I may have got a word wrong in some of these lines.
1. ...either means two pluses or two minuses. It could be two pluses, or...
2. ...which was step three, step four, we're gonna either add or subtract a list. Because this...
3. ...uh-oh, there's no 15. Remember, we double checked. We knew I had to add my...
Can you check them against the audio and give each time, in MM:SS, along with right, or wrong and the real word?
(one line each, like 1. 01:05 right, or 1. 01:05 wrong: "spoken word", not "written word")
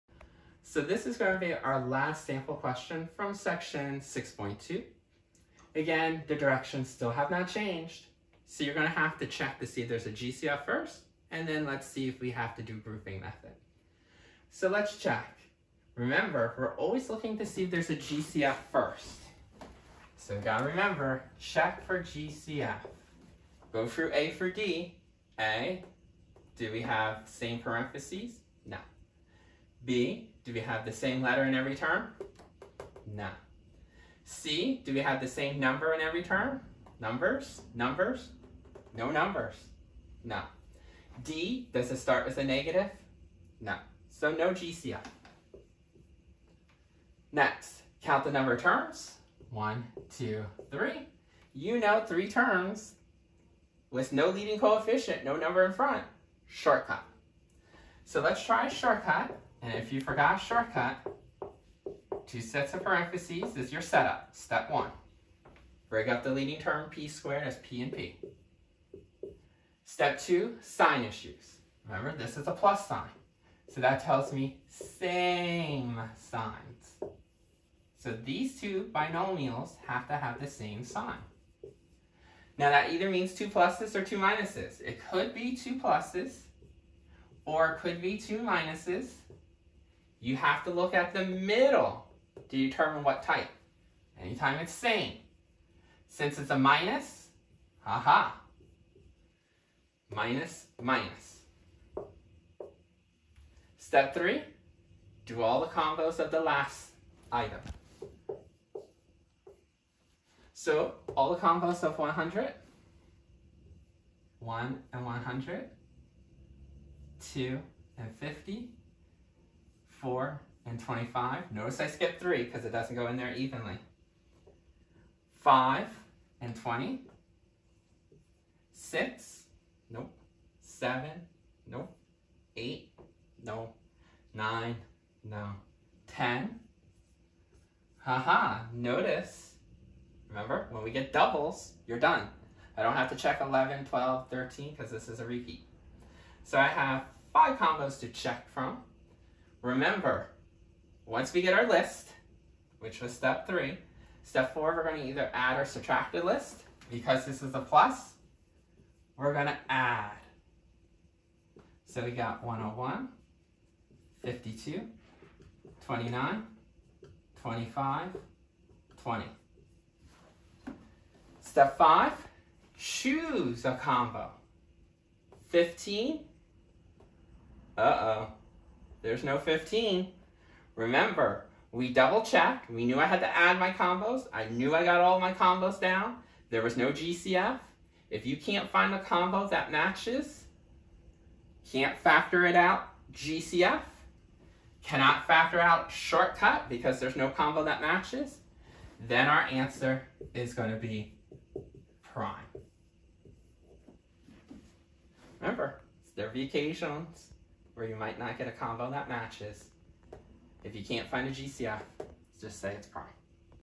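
1. 01:22 right
2. 02:32 right
3. 02:57 right.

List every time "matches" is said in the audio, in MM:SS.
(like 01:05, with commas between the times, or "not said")
03:09, 03:17, 03:29.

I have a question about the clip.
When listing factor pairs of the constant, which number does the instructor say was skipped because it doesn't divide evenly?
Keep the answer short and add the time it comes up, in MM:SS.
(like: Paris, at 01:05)
3, at 02:02.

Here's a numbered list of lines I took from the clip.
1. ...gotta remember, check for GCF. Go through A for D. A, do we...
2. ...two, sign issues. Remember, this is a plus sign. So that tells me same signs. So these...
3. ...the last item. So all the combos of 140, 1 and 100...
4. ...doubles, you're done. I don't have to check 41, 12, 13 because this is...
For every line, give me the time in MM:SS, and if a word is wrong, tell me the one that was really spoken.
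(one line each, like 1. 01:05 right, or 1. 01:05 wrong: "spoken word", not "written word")
1. 00:20 right
2. 01:10 right
3. 01:46 wrong: "100", not "140"
4. 02:21 wrong: "11", not "41".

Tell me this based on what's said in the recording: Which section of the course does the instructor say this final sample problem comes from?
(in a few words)
6.2.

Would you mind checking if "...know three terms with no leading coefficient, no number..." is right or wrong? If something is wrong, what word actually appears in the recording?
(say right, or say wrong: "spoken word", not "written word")
right.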